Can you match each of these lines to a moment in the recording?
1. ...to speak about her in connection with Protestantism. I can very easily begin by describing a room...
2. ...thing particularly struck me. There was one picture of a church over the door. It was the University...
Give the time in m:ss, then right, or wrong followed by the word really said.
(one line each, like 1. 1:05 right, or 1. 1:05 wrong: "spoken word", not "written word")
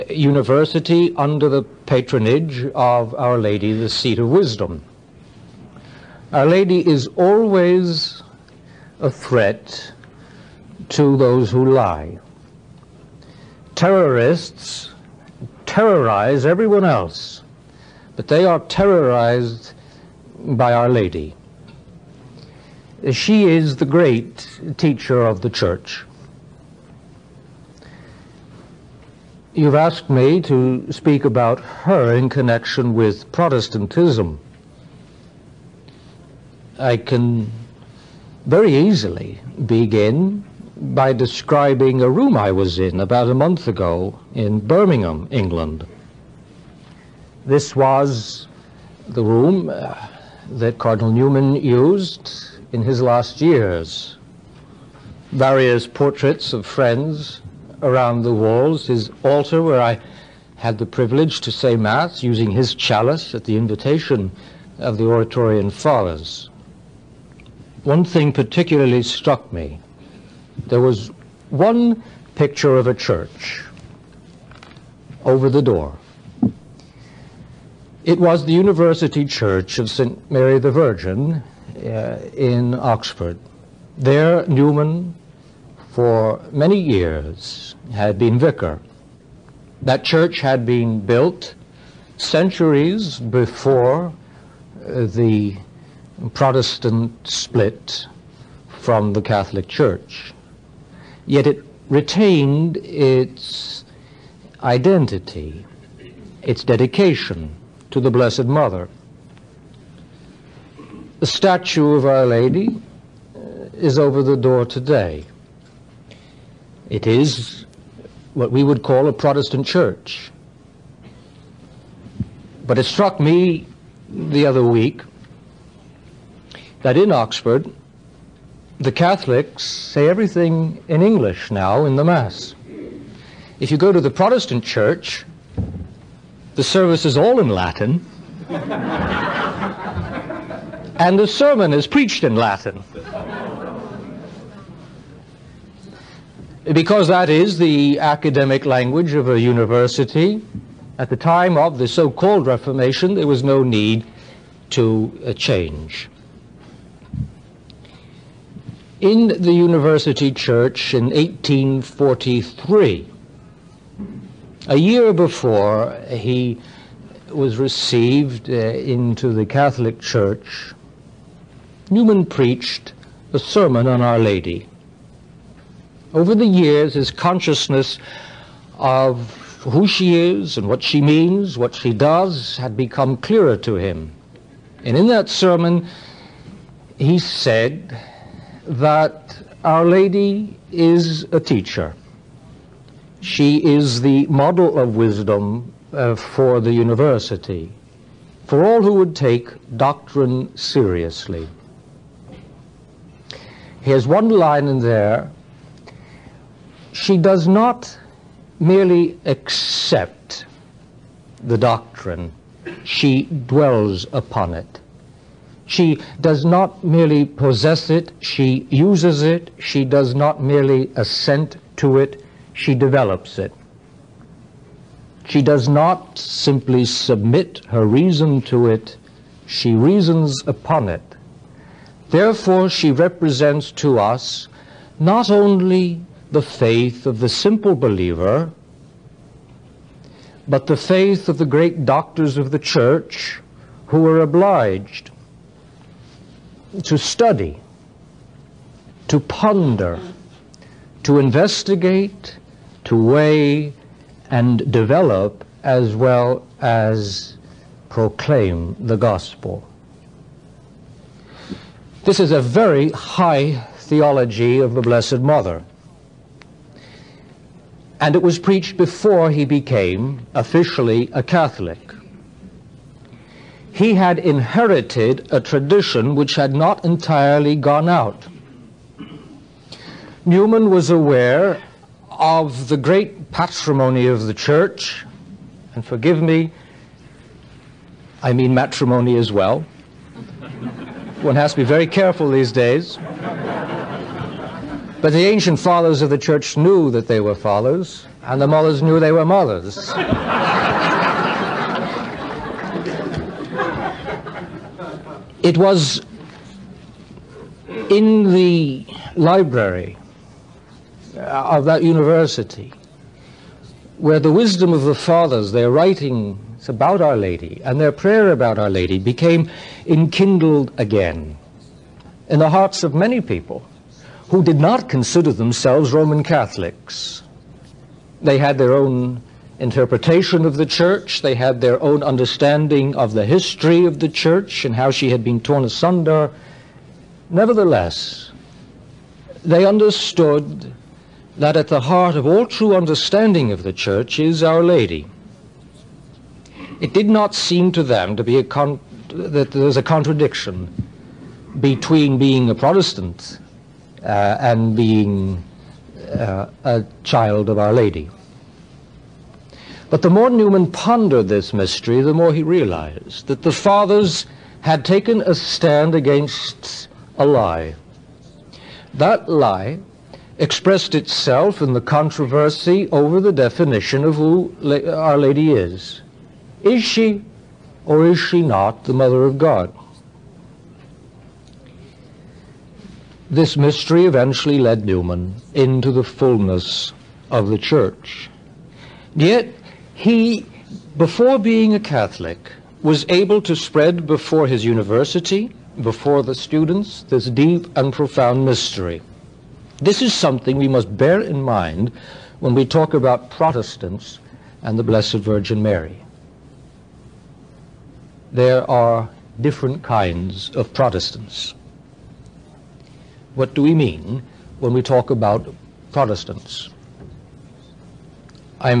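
1. 0:30 right
2. 1:08 right.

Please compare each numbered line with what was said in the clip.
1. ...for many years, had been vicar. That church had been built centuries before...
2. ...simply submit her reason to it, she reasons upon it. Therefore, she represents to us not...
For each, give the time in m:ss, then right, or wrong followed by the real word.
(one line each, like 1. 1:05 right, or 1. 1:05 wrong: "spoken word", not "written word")
1. 1:25 right
2. 3:46 right.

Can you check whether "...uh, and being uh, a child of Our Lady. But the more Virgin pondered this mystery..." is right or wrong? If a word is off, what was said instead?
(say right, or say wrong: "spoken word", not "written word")
wrong: "Newman", not "Virgin".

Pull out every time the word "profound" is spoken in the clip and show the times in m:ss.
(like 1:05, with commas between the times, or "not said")
6:37.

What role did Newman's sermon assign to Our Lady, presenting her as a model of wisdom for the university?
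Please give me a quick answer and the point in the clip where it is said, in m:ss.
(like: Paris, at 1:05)
a teacher, at 3:11.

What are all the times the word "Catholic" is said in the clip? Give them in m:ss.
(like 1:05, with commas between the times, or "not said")
1:39, 2:08, 2:49, 4:31, 5:26, 6:31.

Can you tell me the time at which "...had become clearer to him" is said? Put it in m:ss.
3:02.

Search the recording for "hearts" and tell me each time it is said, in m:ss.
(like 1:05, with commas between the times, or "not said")
5:22, 5:41.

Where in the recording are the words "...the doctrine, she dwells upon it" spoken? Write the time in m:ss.
3:31.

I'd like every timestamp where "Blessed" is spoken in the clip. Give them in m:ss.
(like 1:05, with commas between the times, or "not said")
1:48, 4:24, 6:44.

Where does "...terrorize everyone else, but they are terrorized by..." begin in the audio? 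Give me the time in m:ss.
0:15.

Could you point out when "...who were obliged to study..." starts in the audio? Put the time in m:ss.
4:03.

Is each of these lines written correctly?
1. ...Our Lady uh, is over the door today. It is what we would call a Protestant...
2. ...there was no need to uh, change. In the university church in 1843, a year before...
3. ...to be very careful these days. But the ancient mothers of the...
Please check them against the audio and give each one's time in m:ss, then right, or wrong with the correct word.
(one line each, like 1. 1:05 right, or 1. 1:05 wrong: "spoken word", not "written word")
1. 1:52 right
2. 2:33 right
3. 4:51 wrong: "fathers", not "mothers".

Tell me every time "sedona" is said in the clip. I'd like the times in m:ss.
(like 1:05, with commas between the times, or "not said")
not said.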